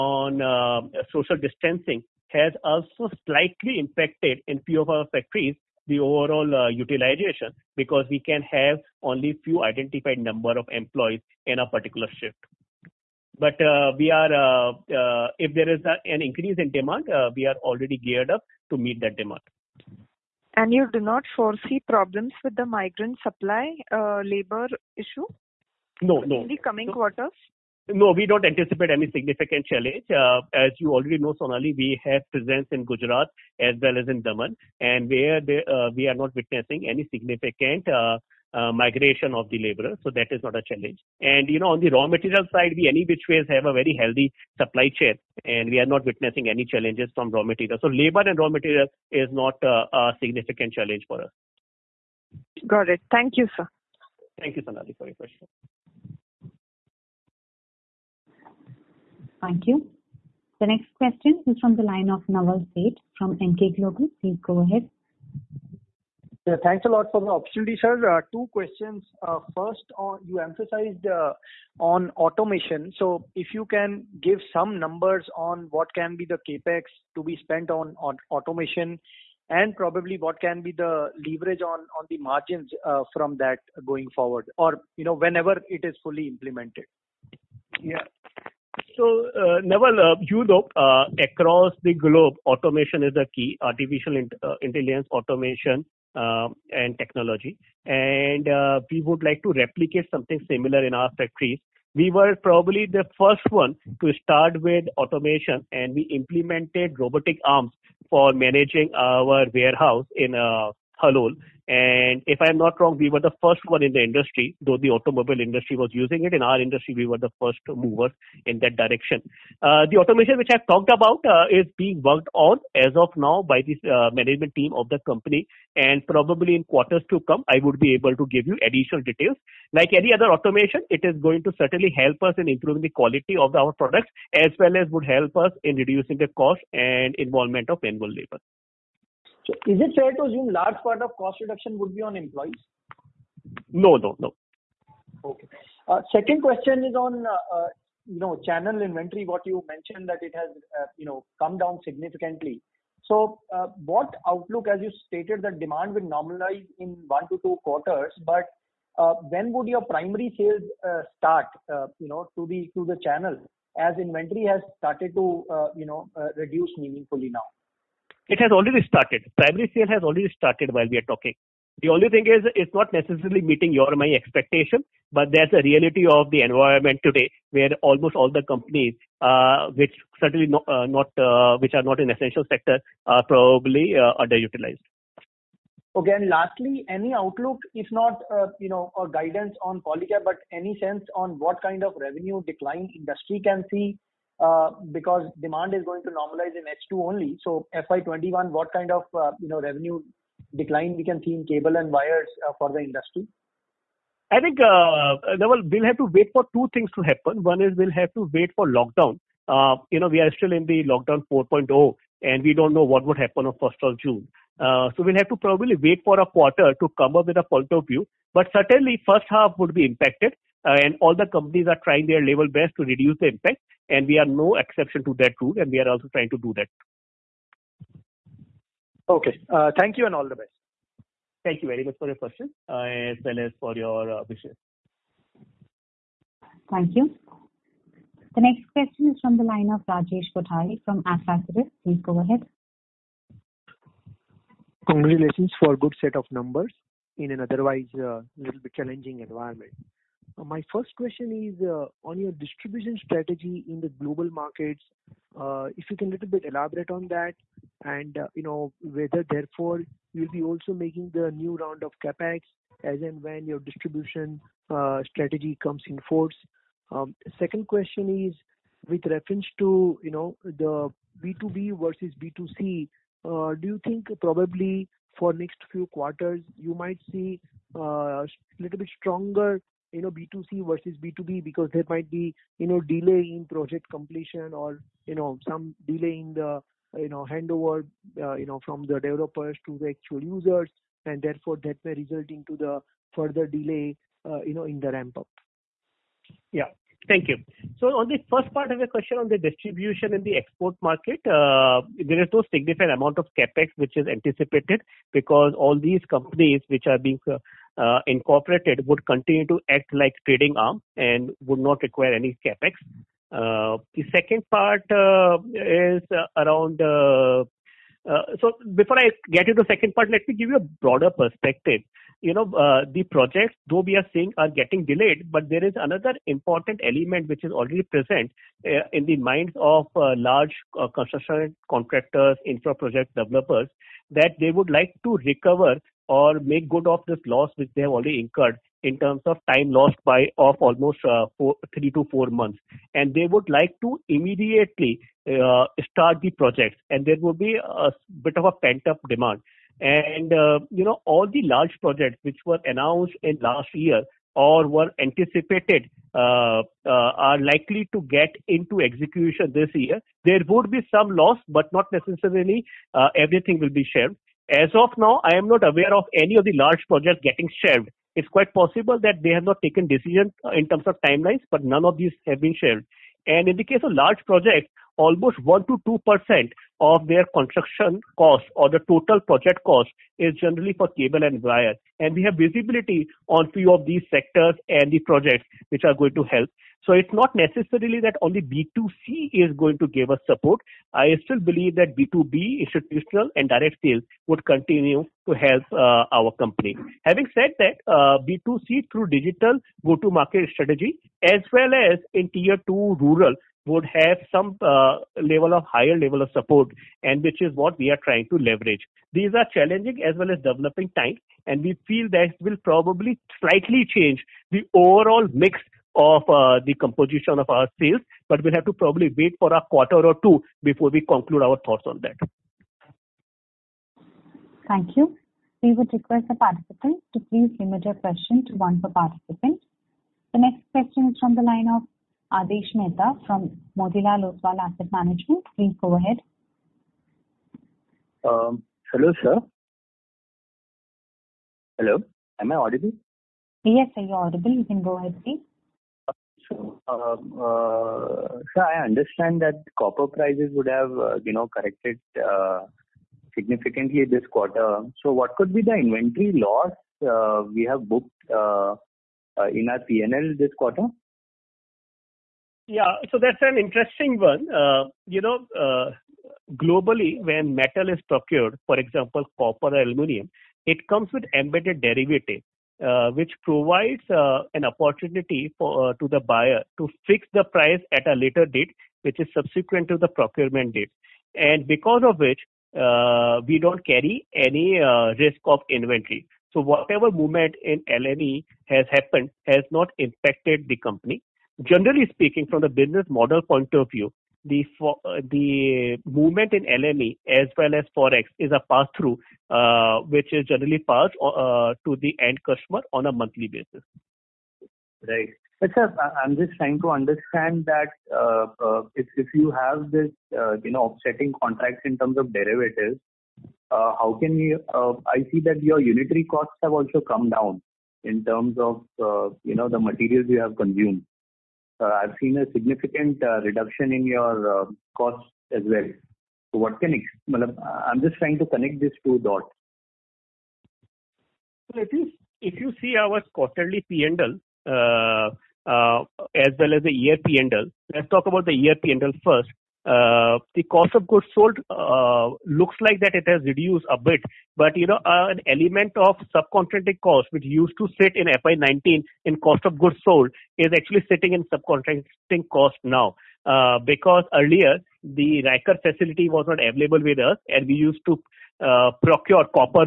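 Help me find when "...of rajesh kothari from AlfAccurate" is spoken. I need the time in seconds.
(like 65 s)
239 s.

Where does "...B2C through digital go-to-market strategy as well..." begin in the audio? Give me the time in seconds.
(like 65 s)
398 s.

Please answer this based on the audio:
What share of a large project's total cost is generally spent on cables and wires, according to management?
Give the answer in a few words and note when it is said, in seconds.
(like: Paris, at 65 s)
1 to 2%, at 375 s.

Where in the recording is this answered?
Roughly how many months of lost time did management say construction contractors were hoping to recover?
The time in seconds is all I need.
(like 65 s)
341 s.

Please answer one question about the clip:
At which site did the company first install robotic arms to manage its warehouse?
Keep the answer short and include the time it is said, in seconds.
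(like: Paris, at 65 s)
Halol, at 111 s.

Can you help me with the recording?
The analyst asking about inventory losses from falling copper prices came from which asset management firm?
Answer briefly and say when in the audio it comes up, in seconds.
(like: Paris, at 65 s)
Motilal Oswal Asset Management, at 433 s.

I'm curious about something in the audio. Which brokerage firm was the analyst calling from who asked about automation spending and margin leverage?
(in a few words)
Emkay Global.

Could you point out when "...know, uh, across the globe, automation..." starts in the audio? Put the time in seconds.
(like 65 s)
90 s.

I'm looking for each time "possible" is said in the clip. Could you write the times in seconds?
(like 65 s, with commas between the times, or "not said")
368 s.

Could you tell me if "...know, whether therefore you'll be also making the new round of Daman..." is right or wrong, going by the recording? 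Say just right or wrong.
wrong.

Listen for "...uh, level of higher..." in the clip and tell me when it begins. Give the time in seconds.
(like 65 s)
404 s.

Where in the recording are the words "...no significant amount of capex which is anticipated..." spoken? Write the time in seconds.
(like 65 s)
302 s.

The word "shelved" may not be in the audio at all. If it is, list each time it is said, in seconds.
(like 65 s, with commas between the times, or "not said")
367 s, 372 s.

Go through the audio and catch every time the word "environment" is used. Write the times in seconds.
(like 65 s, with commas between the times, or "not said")
176 s, 249 s.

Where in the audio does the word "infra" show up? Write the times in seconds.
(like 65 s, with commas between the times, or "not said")
332 s.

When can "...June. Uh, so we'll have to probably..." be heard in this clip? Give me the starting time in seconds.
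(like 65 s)
214 s.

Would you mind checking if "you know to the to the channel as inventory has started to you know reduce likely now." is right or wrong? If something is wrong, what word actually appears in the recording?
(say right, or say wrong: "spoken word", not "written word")
wrong: "meaningfully", not "likely".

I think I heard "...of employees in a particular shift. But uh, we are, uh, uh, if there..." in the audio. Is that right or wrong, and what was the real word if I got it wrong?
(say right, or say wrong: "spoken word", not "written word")
right.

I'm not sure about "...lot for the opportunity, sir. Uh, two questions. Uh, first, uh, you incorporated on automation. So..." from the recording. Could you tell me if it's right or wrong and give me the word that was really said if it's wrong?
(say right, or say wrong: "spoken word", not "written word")
wrong: "emphasized", not "incorporated".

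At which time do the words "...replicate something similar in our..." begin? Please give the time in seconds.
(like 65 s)
99 s.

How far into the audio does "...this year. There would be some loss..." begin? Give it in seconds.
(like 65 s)
359 s.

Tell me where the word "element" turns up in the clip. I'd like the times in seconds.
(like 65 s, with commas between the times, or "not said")
326 s, 545 s.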